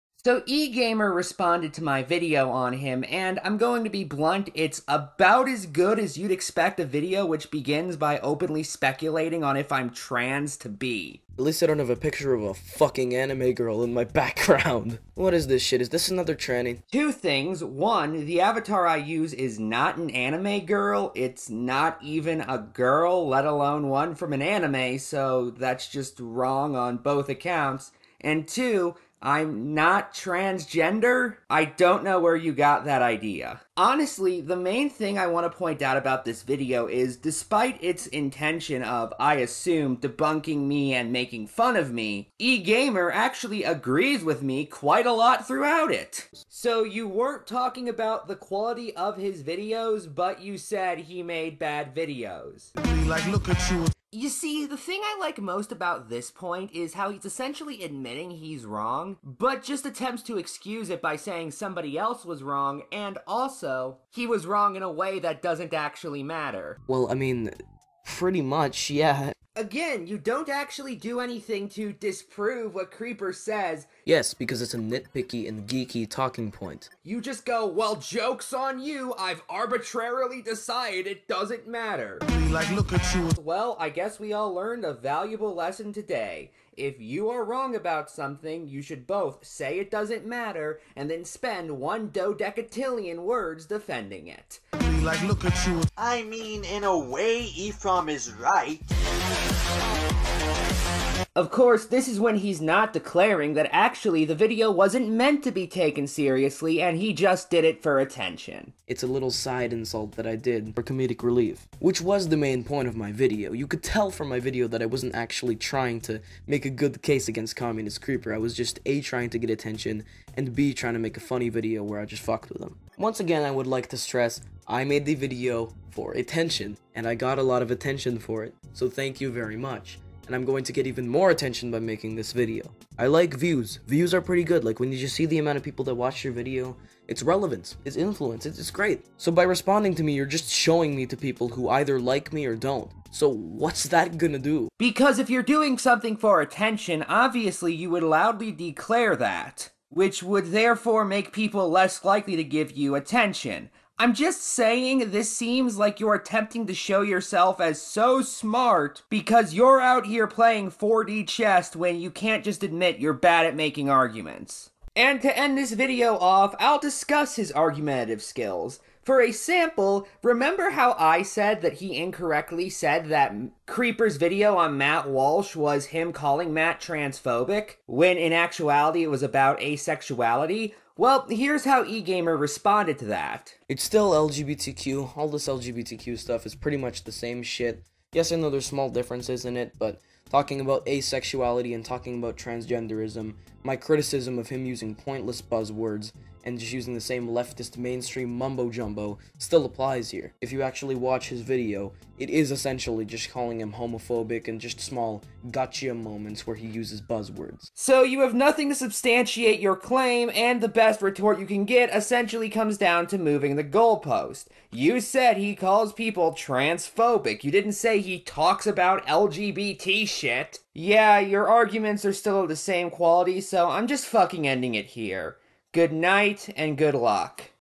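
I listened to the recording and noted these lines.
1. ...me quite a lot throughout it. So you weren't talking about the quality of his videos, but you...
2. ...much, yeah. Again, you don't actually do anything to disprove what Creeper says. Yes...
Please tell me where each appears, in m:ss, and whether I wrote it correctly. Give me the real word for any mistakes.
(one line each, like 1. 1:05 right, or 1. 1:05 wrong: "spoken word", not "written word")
1. 0:44 right
2. 1:08 right.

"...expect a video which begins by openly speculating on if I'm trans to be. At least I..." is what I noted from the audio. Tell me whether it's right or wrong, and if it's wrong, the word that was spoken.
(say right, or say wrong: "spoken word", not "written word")
right.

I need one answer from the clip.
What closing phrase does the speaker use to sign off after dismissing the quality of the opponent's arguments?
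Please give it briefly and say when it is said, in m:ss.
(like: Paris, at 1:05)
Good night and good luck, at 3:45.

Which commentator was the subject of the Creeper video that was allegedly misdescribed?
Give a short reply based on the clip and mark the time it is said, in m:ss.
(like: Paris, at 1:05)
Matt Walsh, at 2:54.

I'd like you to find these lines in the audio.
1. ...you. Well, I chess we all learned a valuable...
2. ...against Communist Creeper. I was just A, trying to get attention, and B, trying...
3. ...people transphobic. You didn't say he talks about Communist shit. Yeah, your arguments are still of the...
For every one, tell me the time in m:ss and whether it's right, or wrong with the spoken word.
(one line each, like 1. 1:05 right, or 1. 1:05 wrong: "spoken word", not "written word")
1. 1:23 wrong: "guess", not "chess"
2. 1:57 right
3. 3:35 wrong: "LGBT", not "Communist".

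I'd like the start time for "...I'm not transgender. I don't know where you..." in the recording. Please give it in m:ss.
0:29.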